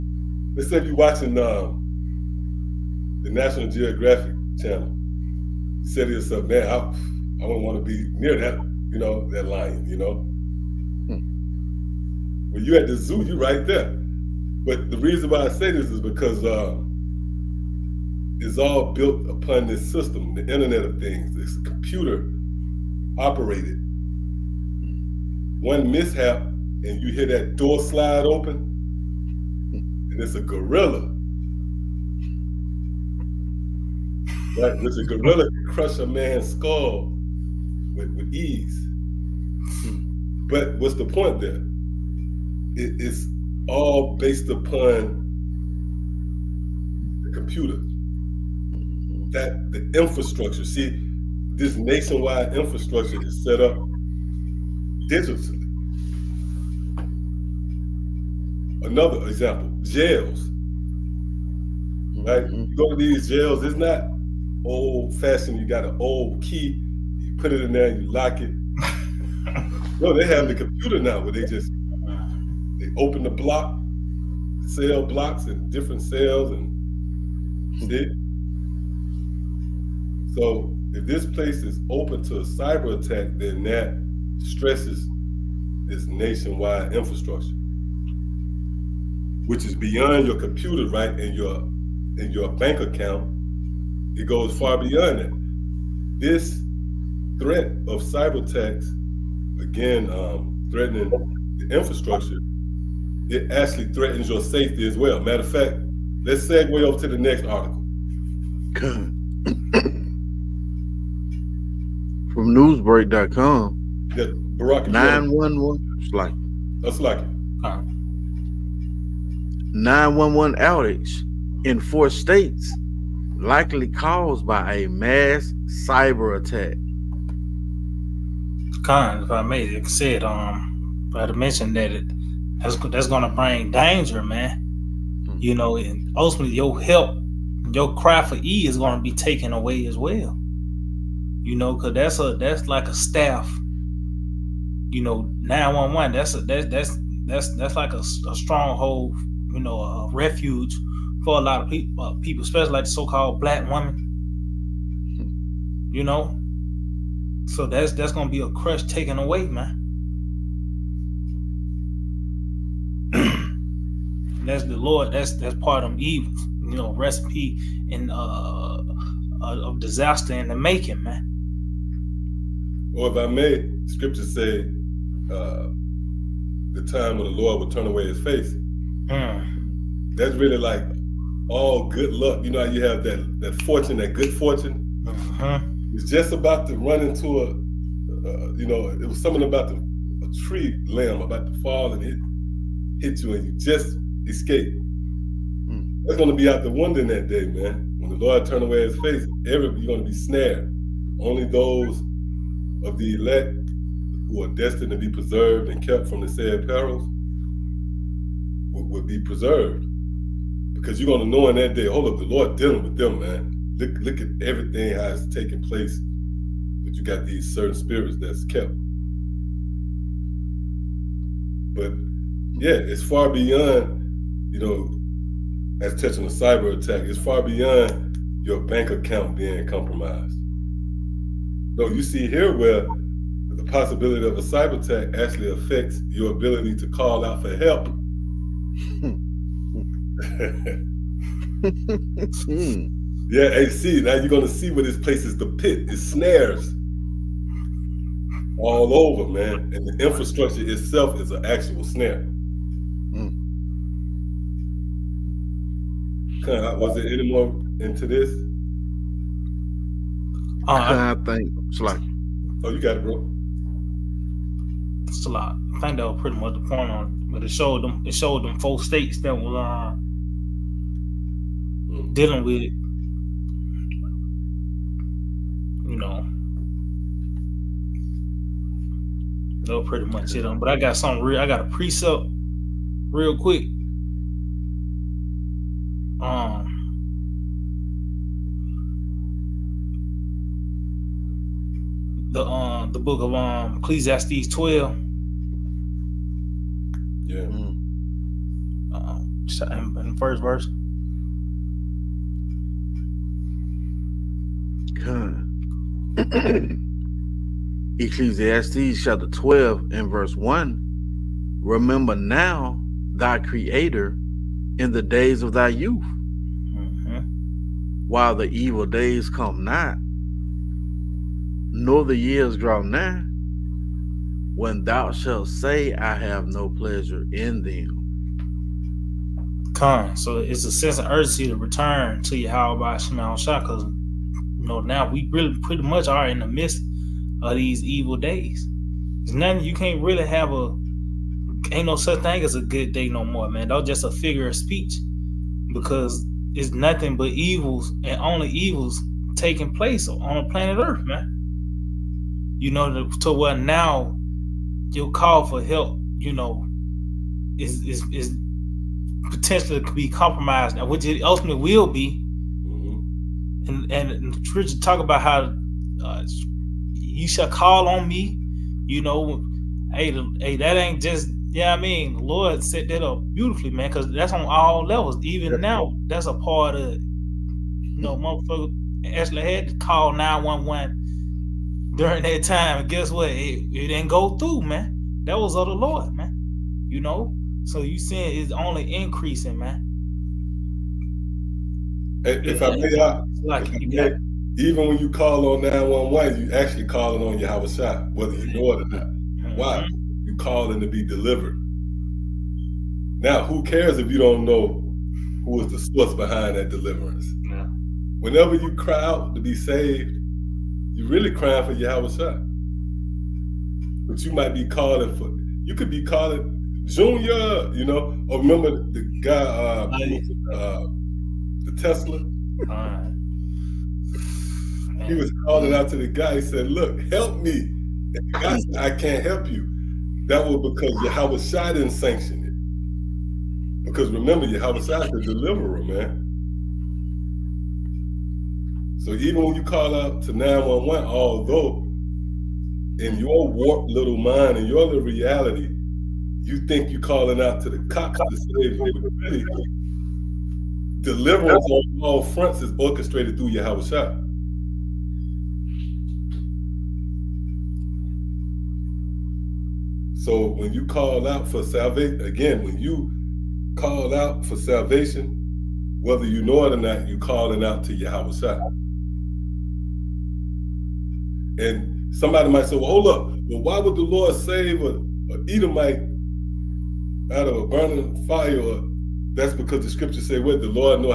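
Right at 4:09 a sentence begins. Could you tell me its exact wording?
And the infrastructure itself is an actual snare.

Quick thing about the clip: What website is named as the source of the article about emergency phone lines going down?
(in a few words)
newsbreak.com.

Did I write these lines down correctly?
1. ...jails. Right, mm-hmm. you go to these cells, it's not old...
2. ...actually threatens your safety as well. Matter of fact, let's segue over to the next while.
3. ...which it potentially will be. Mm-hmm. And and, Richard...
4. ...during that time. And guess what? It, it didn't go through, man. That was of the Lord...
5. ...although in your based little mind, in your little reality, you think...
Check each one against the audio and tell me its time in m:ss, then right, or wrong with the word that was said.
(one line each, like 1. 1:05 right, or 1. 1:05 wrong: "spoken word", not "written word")
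1. 0:59 wrong: "jails", not "cells"
2. 1:43 wrong: "article", not "while"
3. 6:00 wrong: "ultimately", not "potentially"
4. 6:21 right
5. 7:21 wrong: "warped", not "based".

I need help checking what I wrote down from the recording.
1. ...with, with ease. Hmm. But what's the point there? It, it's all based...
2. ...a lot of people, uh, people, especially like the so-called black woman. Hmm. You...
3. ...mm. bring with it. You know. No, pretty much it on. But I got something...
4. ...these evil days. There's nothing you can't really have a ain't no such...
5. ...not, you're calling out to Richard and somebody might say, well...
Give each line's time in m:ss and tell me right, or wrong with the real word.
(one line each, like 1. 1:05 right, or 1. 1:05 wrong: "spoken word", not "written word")
1. 0:37 right
2. 2:31 right
3. 4:31 wrong: "dealing", not "bring"
4. 5:37 right
5. 7:46 wrong: "Yahweh", not "Richard".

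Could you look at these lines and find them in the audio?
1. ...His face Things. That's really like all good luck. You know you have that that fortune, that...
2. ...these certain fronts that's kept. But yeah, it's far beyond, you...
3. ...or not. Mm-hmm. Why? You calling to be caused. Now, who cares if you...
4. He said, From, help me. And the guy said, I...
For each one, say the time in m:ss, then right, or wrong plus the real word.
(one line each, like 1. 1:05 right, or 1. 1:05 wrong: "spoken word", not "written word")
1. 2:58 wrong: "Hmm", not "Things"
2. 3:37 wrong: "spirits", not "fronts"
3. 6:38 wrong: "delivered", not "caused"
4. 7:06 wrong: "Look", not "From".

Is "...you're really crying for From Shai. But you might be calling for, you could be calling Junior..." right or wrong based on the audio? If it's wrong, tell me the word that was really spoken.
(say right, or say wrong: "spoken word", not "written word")
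wrong: "Yahweh", not "From".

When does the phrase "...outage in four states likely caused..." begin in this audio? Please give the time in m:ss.
2:00.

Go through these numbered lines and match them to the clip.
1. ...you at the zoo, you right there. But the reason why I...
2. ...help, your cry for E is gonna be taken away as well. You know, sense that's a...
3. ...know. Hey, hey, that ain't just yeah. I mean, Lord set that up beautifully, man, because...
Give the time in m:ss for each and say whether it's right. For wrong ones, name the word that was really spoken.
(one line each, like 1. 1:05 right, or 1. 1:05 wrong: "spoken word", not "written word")
1. 0:12 right
2. 2:16 wrong: "cause", not "sense"
3. 6:09 right.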